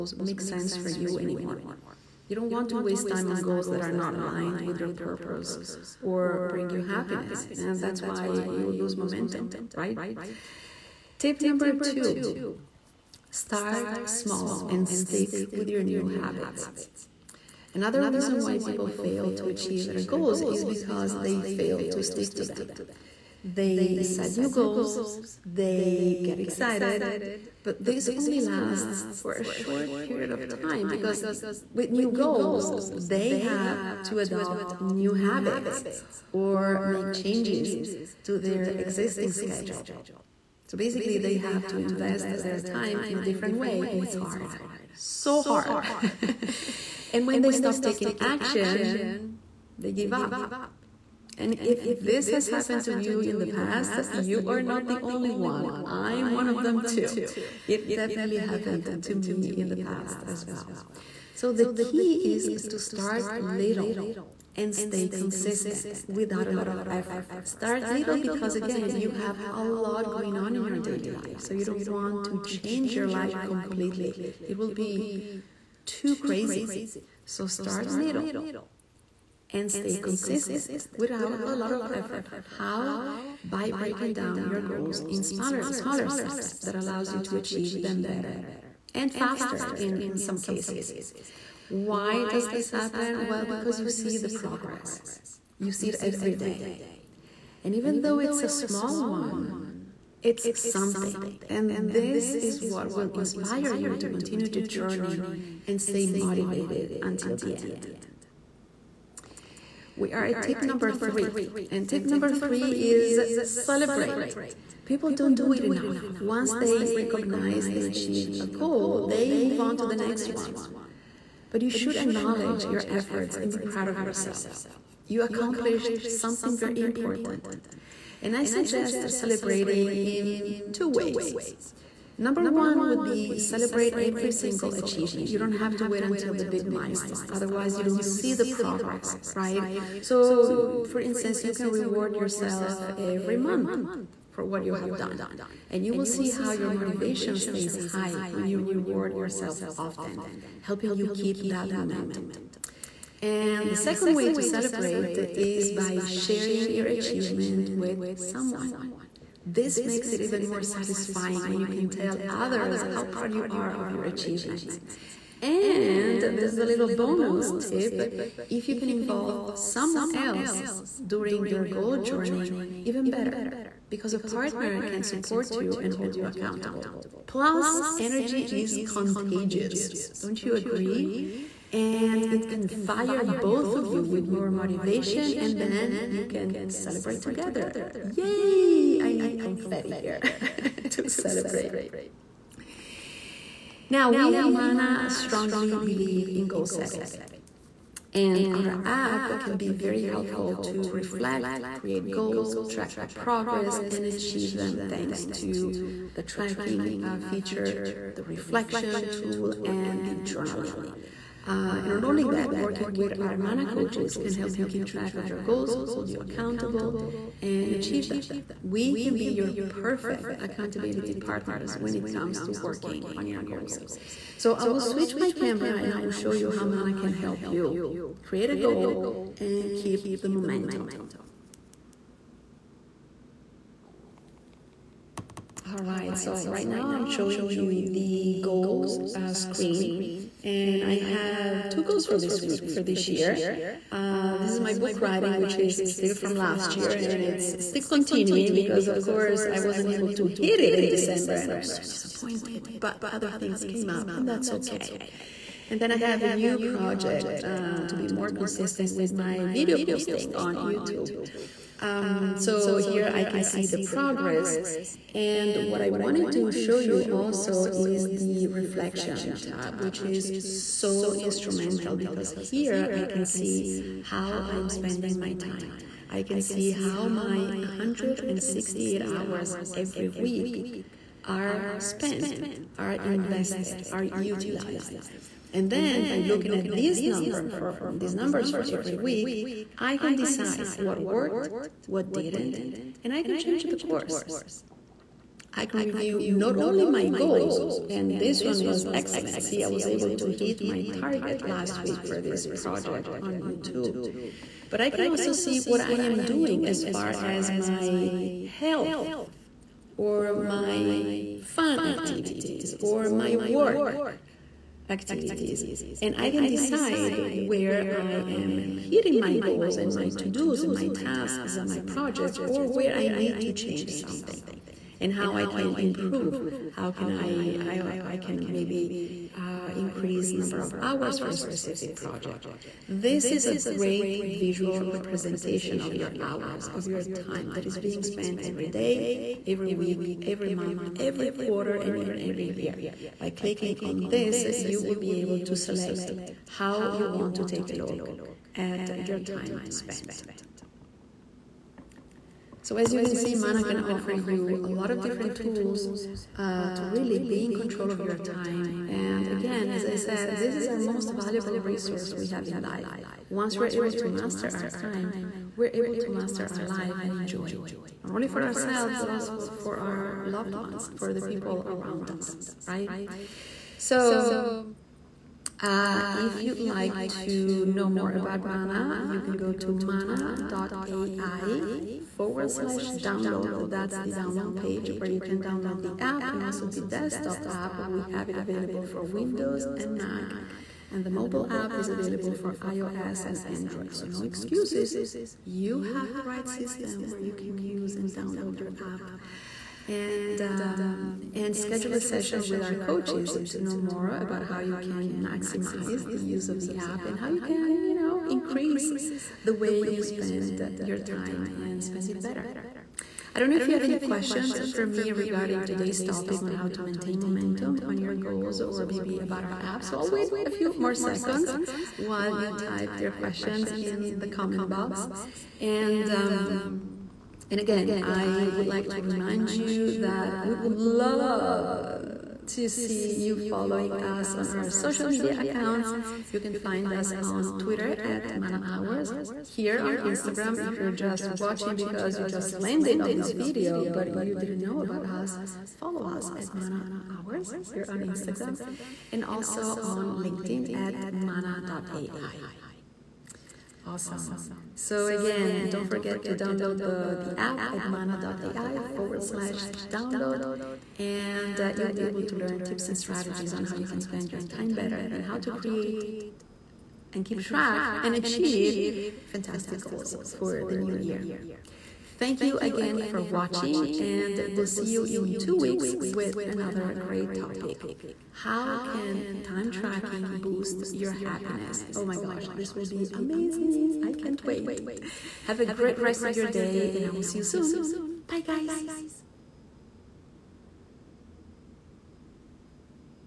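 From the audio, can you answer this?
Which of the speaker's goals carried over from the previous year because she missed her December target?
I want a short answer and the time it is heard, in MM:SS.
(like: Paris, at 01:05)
book writing, at 04:04.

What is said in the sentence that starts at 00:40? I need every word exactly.
So basically, they have to invest their time in a different way, and it's hard.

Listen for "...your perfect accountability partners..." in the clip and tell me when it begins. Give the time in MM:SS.
03:39.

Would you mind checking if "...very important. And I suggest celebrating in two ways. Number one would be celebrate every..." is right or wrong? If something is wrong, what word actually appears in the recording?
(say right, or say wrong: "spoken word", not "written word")
right.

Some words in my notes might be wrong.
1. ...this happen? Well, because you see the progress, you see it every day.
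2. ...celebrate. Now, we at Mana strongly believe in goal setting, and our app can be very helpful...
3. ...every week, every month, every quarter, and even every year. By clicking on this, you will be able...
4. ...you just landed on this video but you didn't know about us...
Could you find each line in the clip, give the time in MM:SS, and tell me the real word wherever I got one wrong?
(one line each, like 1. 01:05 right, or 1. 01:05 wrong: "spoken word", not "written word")
1. 01:32 right
2. 03:11 right
3. 05:39 right
4. 07:22 right.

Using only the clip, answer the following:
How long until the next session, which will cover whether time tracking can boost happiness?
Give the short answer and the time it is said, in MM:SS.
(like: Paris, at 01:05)
two weeks, at 07:55.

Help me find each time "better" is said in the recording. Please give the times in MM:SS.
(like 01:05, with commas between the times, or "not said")
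01:28, 02:53, 06:52, 07:44.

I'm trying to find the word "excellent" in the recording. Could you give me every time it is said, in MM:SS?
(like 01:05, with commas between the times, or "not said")
04:58.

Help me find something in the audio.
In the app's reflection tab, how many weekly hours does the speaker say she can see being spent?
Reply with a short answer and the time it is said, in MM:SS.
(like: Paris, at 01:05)
168, at 04:37.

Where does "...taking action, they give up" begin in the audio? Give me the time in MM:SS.
00:47.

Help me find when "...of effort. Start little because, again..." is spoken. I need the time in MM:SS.
01:06.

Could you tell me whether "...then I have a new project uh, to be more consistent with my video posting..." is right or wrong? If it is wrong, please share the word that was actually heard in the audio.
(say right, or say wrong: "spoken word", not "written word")
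right.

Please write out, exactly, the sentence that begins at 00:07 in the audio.
And that's why you will lose momentum, right?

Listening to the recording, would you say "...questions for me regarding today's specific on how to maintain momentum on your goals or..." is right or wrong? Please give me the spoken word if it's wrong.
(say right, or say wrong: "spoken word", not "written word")
wrong: "topic", not "specific".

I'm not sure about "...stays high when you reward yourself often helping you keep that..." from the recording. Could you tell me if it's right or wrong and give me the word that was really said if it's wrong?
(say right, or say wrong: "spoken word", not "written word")
right.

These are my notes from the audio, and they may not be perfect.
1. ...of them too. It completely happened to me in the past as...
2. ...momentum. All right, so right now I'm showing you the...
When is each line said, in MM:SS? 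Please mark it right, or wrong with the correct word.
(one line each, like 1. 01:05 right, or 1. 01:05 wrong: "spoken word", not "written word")
1. 00:56 wrong: "definitely", not "completely"
2. 03:50 right.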